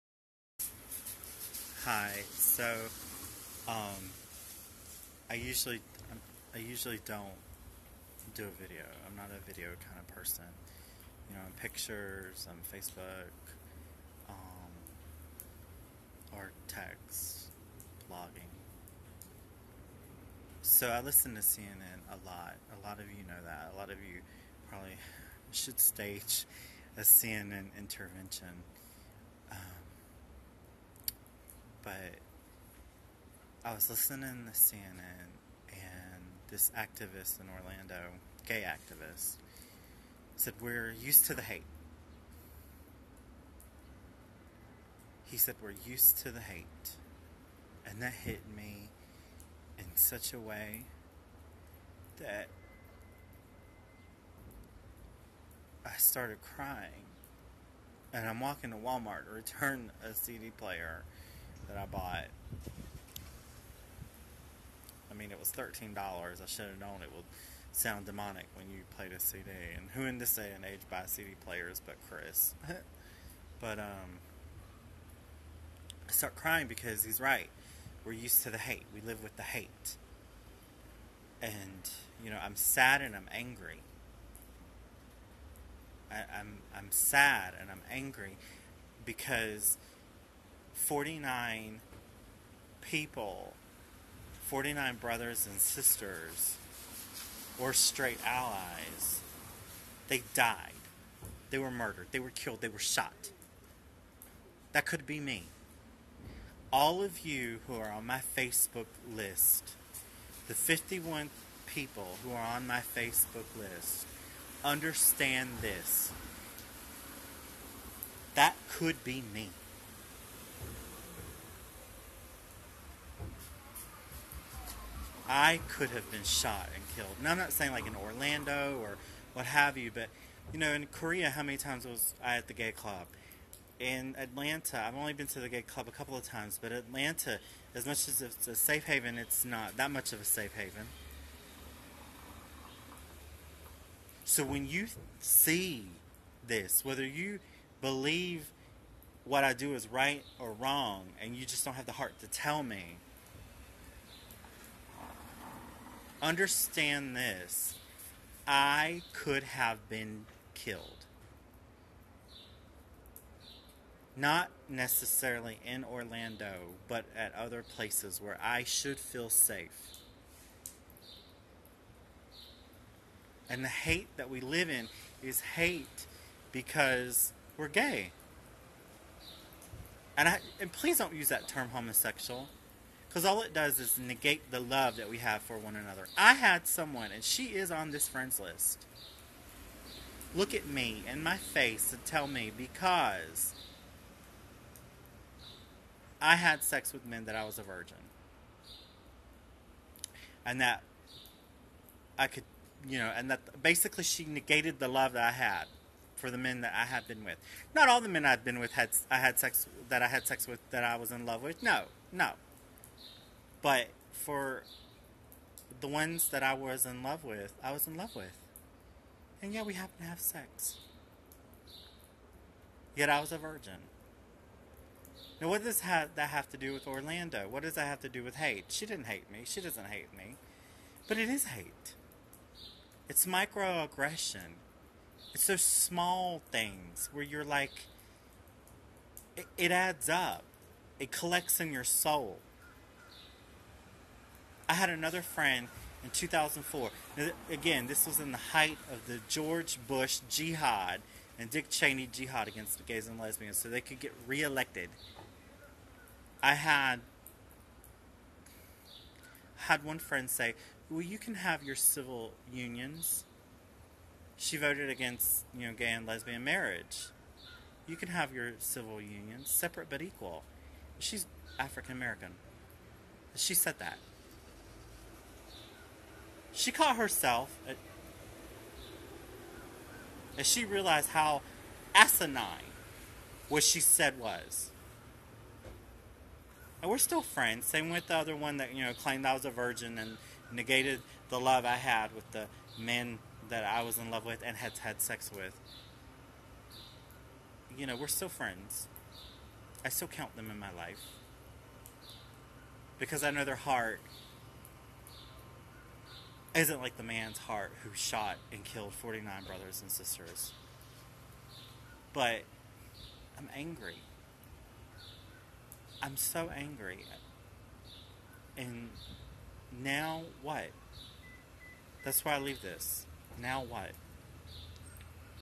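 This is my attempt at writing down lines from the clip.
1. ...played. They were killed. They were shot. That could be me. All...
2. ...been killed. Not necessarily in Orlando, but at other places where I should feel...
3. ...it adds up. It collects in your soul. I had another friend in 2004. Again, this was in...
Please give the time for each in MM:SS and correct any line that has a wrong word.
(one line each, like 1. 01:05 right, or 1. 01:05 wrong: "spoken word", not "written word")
1. 01:41 wrong: "murdered", not "played"
2. 02:39 right
3. 03:59 right.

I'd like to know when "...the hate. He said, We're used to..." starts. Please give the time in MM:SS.
00:41.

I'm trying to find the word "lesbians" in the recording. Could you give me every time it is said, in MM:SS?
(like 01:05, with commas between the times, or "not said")
04:13, 04:26.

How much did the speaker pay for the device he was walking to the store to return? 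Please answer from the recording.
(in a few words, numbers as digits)
$13.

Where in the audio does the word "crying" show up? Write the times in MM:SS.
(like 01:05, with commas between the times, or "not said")
00:56, 01:16.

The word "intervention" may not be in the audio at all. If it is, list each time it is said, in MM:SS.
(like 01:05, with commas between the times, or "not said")
00:27.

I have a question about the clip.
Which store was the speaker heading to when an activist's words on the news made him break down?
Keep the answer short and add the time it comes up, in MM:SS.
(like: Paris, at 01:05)
Walmart, at 00:58.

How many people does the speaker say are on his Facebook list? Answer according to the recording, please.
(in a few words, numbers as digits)
51.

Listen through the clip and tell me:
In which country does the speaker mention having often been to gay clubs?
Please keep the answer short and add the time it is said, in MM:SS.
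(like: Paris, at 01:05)
Korea, at 02:10.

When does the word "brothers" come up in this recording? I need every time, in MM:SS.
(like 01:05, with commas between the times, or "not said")
01:34, 05:09.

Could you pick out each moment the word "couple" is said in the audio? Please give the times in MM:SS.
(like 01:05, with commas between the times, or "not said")
02:15.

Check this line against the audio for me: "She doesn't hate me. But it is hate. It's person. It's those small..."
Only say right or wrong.
wrong.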